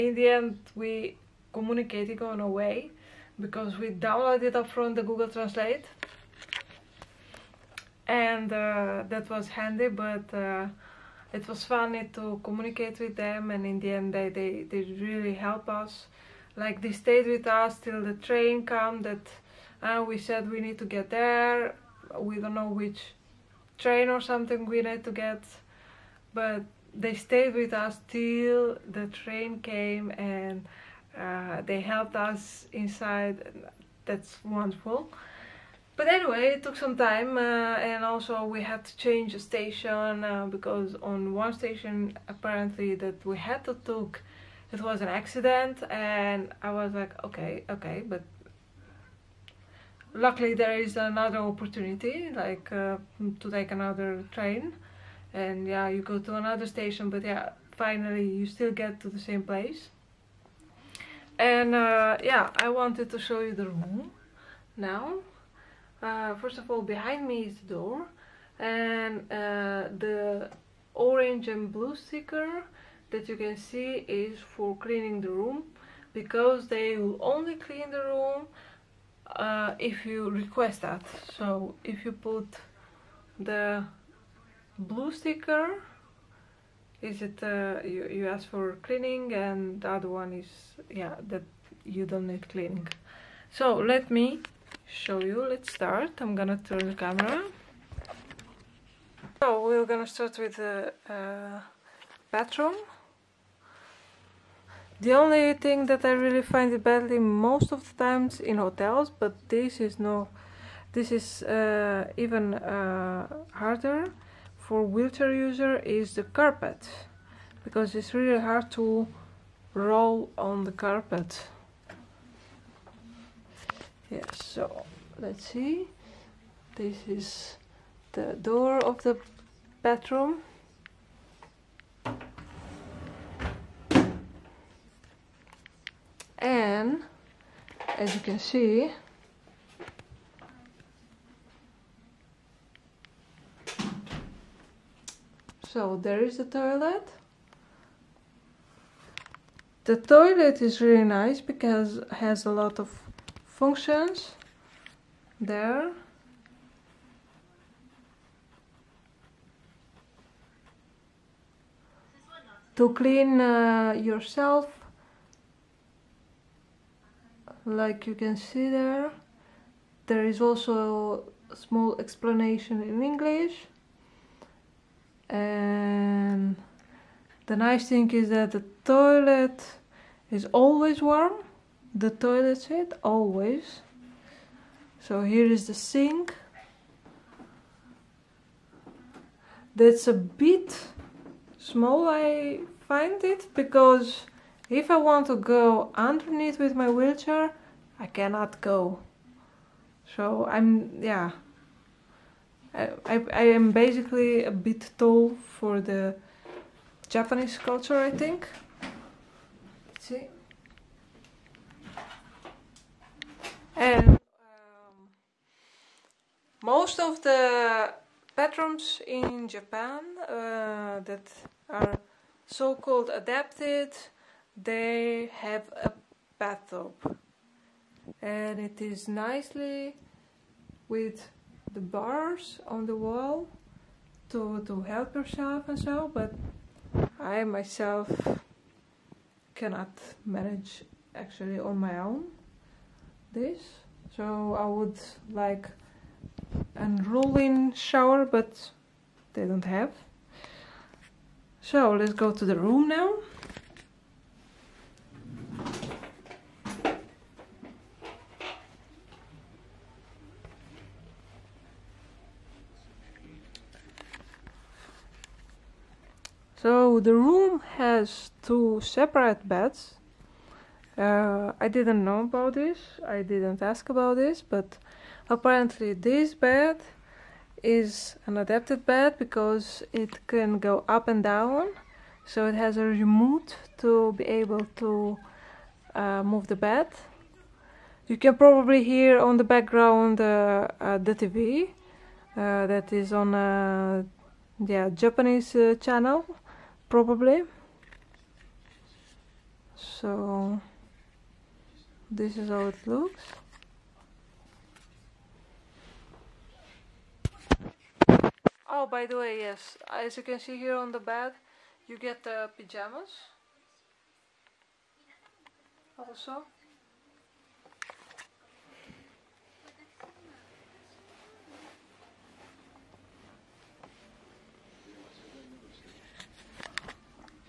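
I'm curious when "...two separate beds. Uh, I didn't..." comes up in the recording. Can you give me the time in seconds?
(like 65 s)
268 s.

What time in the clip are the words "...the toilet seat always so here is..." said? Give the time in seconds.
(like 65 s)
181 s.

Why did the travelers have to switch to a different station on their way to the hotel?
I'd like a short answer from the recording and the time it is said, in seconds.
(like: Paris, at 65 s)
an accident, at 45 s.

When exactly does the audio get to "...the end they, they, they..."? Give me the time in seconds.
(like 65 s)
13 s.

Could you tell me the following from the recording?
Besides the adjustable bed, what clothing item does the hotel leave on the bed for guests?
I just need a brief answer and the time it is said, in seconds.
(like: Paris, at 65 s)
pajamas, at 312 s.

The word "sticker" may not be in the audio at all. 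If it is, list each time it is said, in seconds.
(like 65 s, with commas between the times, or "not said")
71 s, 85 s.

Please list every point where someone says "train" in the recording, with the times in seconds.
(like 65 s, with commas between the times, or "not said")
18 s, 23 s, 29 s, 54 s.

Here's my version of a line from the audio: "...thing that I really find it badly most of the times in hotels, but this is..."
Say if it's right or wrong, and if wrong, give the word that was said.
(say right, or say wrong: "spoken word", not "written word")
right.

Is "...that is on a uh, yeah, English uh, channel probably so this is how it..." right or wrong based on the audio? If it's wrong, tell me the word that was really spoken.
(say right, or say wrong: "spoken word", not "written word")
wrong: "Japanese", not "English".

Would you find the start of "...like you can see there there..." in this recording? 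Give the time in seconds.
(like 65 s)
167 s.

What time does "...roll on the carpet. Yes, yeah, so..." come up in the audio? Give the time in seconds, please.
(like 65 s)
119 s.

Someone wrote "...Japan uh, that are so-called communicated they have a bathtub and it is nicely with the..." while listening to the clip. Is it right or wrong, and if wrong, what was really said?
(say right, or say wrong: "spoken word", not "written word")
wrong: "adapted", not "communicated".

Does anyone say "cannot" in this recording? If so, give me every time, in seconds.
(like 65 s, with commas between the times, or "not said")
198 s, 239 s.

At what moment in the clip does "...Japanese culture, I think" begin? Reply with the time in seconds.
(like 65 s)
207 s.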